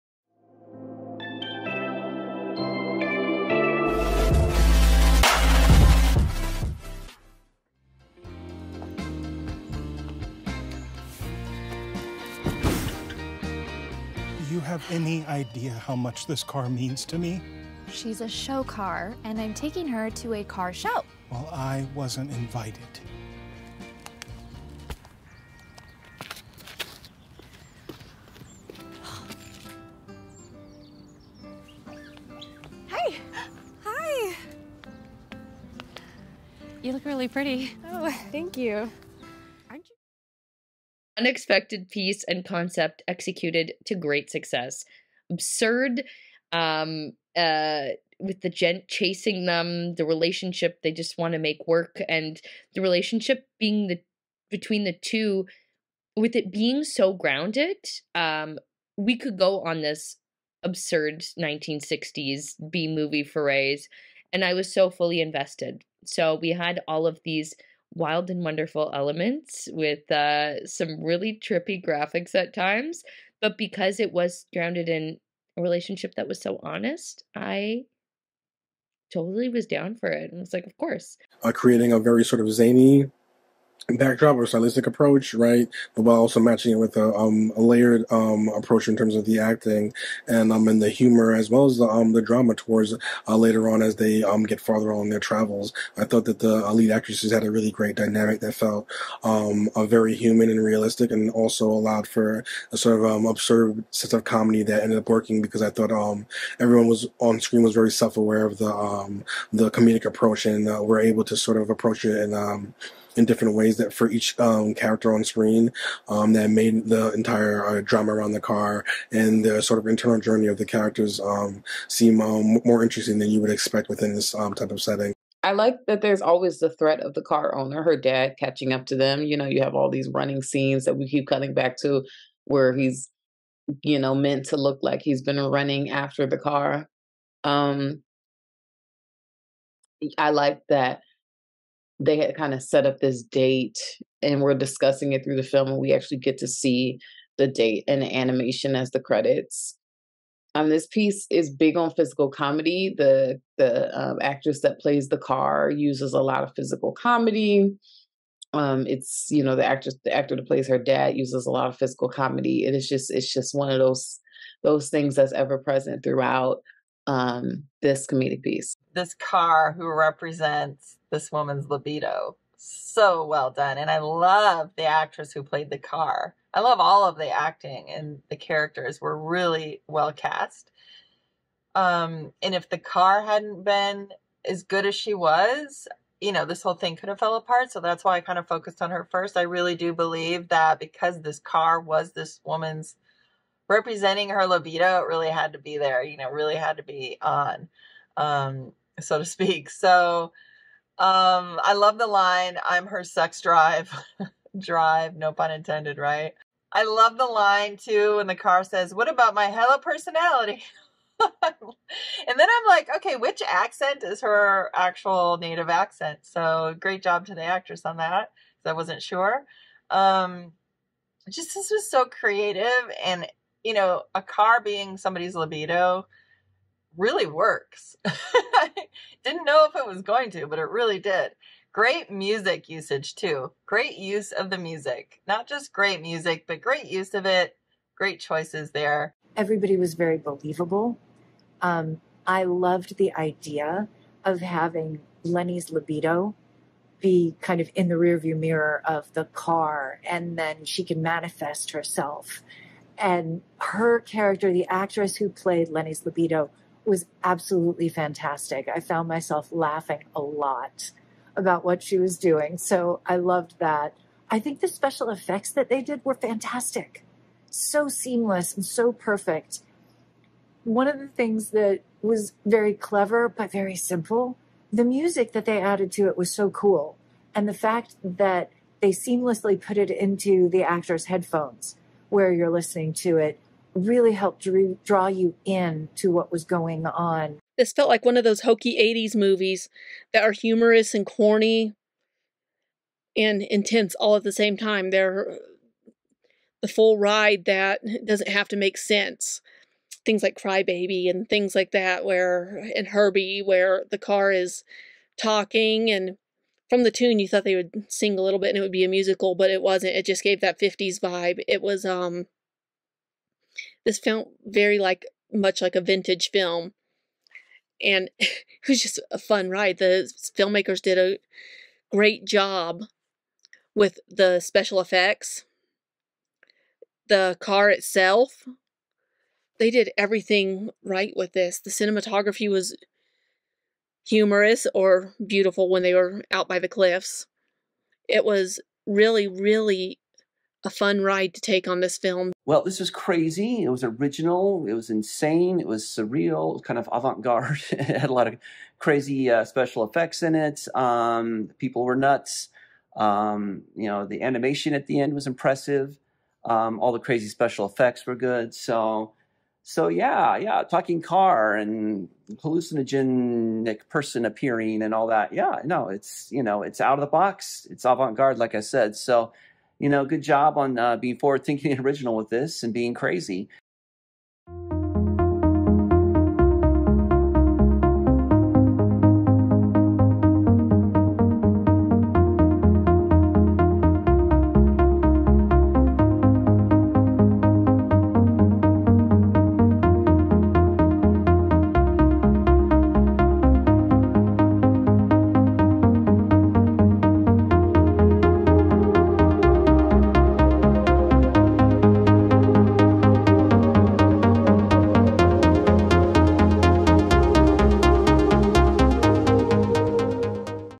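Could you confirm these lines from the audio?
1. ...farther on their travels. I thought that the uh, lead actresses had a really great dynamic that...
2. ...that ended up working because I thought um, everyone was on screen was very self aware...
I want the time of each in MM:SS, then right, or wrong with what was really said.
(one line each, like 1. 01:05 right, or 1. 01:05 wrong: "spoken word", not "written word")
1. 01:34 right
2. 01:44 right.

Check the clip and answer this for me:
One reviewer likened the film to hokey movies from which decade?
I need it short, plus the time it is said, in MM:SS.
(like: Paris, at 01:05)
80s, at 04:48.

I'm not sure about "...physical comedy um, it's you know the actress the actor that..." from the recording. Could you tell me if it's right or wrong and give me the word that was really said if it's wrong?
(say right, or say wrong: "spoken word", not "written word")
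right.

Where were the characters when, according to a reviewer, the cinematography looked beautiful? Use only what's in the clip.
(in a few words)
By the cliffs.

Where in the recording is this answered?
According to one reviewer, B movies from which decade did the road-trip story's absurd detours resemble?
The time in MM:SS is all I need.
01:01.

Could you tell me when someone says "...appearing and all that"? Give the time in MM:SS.
06:04.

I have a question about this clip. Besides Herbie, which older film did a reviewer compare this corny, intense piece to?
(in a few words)
Crybaby.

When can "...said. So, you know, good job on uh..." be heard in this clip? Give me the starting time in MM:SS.
06:08.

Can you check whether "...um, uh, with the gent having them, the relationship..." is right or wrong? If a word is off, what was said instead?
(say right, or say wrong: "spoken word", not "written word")
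wrong: "chasing", not "having".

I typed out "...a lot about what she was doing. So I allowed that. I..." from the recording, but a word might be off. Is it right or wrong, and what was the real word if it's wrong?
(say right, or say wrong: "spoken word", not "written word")
wrong: "loved", not "allowed".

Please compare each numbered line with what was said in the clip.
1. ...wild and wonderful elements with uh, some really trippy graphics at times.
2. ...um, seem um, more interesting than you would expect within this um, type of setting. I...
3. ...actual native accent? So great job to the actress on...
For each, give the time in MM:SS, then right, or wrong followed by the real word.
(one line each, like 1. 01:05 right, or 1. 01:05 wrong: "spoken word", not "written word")
1. 01:07 right
2. 02:01 right
3. 03:34 right.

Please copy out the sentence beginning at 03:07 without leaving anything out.
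So that's why I kind of focused on her first.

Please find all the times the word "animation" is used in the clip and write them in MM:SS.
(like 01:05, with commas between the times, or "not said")
02:28, 05:54.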